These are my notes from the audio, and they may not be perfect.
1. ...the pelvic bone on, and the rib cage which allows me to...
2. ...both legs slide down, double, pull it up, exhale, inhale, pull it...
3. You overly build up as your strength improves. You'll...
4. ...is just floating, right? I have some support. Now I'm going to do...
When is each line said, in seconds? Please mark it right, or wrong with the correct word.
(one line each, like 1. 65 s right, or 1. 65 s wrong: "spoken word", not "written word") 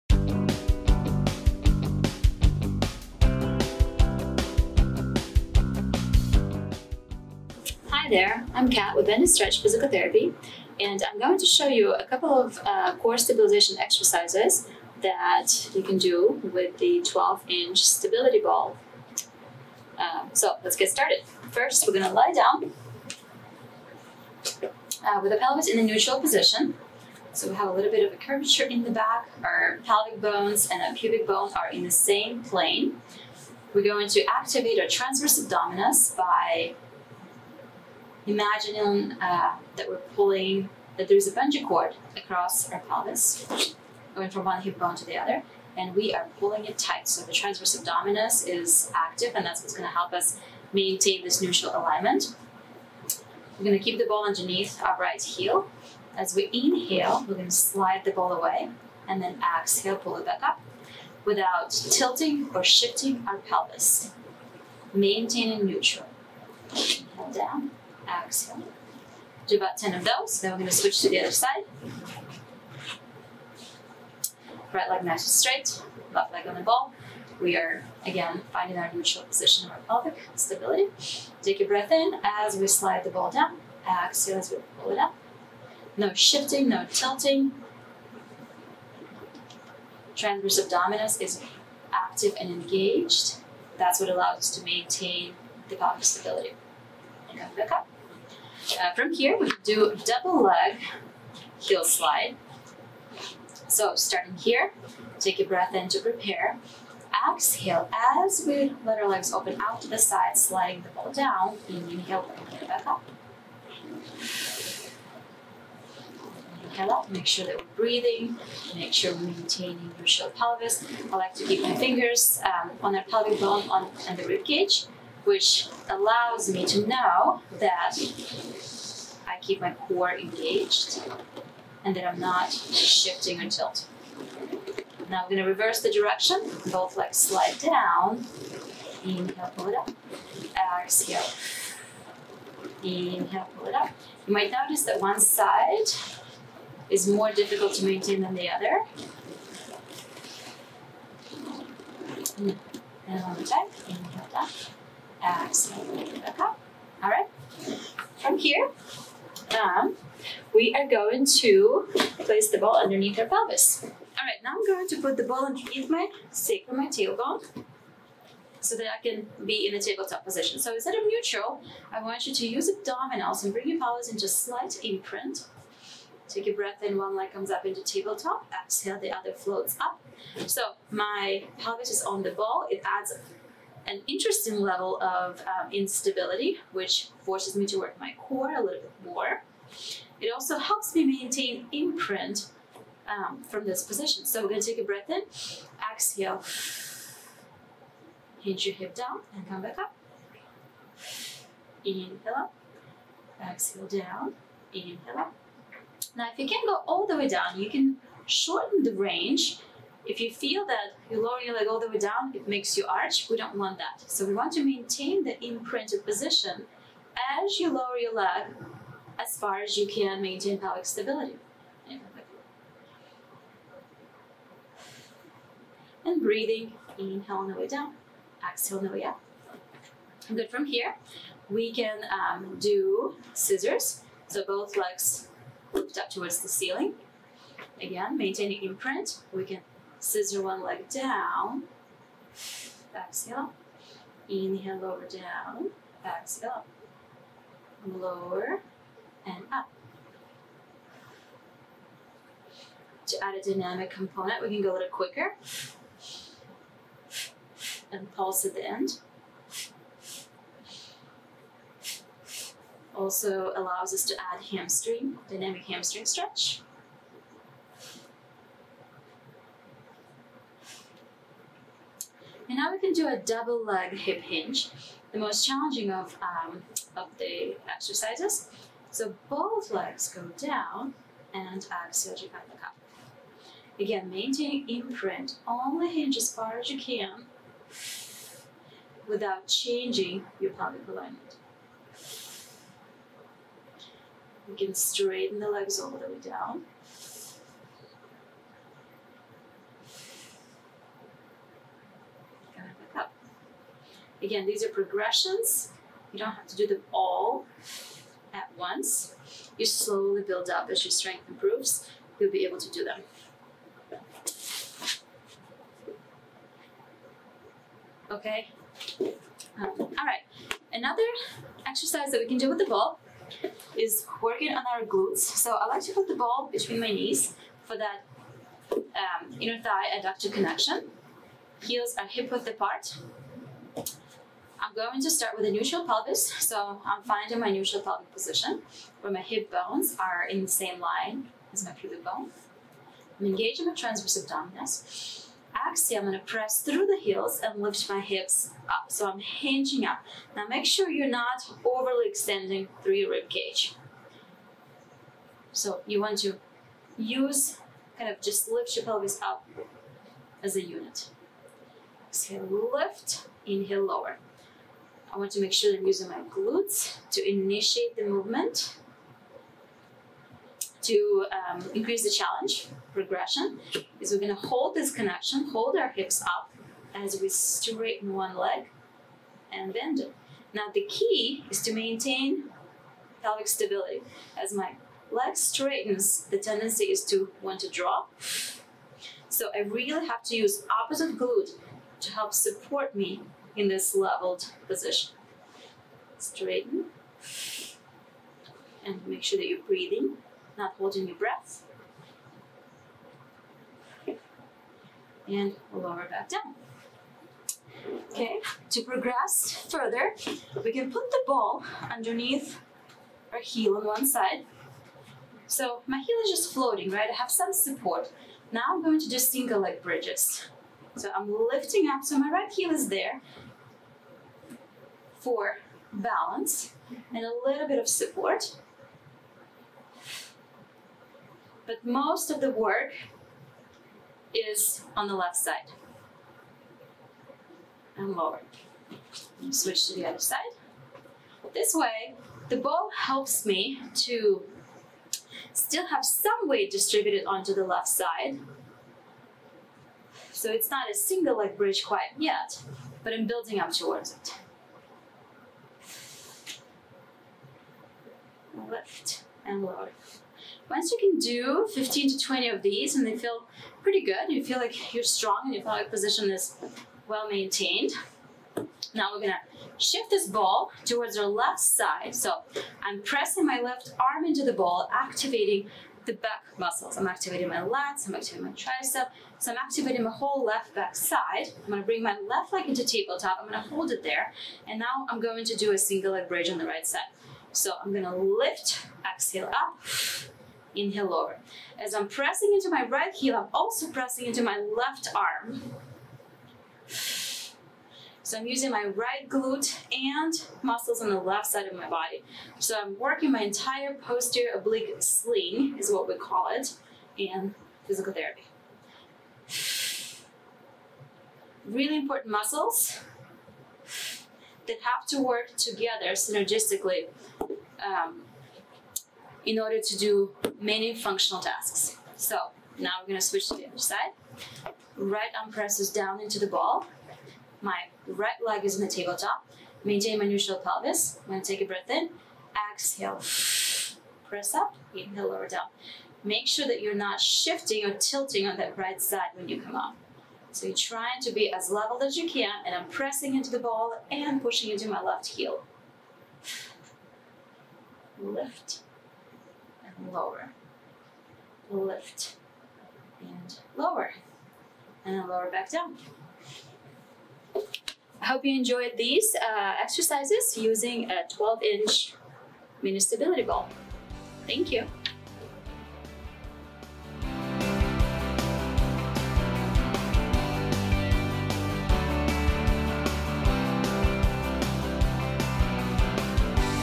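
1. 122 s right
2. 136 s wrong: "inhale", not "double"
3. 309 s wrong: "slowly", not "overly"
4. 416 s right.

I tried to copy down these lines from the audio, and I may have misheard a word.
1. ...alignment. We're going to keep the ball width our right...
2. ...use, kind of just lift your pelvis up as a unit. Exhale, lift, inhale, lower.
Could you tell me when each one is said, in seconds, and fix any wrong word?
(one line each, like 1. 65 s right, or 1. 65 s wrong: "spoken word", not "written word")
1. 51 s wrong: "underneath", not "width"
2. 356 s right.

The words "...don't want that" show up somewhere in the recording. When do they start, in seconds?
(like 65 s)
213 s.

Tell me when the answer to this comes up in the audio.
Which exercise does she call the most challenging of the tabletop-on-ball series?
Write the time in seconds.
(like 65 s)
273 s.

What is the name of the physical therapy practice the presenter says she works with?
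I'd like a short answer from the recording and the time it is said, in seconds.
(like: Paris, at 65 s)
Bend Stretch Physical Therapy, at 9 s.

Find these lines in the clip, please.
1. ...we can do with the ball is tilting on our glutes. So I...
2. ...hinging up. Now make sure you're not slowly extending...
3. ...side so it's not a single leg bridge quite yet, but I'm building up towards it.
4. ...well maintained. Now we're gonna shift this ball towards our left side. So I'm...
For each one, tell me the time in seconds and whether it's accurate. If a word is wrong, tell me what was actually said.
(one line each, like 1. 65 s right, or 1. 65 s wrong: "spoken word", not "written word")
1. 322 s wrong: "working", not "tilting"
2. 349 s wrong: "overly", not "slowly"
3. 447 s right
4. 467 s right.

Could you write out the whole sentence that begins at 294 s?
You can straighten the legs all the way down.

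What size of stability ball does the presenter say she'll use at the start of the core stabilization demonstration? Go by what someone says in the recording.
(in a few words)
12-inch.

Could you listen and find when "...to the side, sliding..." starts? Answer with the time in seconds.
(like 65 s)
109 s.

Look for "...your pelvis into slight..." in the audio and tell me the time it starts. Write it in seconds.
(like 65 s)
173 s.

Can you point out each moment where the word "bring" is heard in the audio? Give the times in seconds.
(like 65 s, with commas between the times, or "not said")
112 s, 173 s, 481 s.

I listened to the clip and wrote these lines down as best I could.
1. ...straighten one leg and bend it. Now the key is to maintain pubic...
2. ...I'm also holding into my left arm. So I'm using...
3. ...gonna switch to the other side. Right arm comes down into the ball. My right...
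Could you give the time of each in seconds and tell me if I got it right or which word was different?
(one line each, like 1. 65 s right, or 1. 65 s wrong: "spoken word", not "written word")
1. 377 s wrong: "pelvic", not "pubic"
2. 493 s wrong: "pressing", not "holding"
3. 523 s wrong: "presses", not "comes".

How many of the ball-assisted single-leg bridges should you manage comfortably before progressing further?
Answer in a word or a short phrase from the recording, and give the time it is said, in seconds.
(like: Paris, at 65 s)
15 to 20, at 461 s.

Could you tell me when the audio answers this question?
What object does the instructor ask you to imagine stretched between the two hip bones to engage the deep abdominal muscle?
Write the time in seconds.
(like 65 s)
41 s.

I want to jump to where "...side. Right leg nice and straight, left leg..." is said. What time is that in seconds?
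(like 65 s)
71 s.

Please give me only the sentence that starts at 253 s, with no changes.
To add a dynamic component, we can go a little quicker and pulse at the end.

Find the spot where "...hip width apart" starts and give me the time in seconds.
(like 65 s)
332 s.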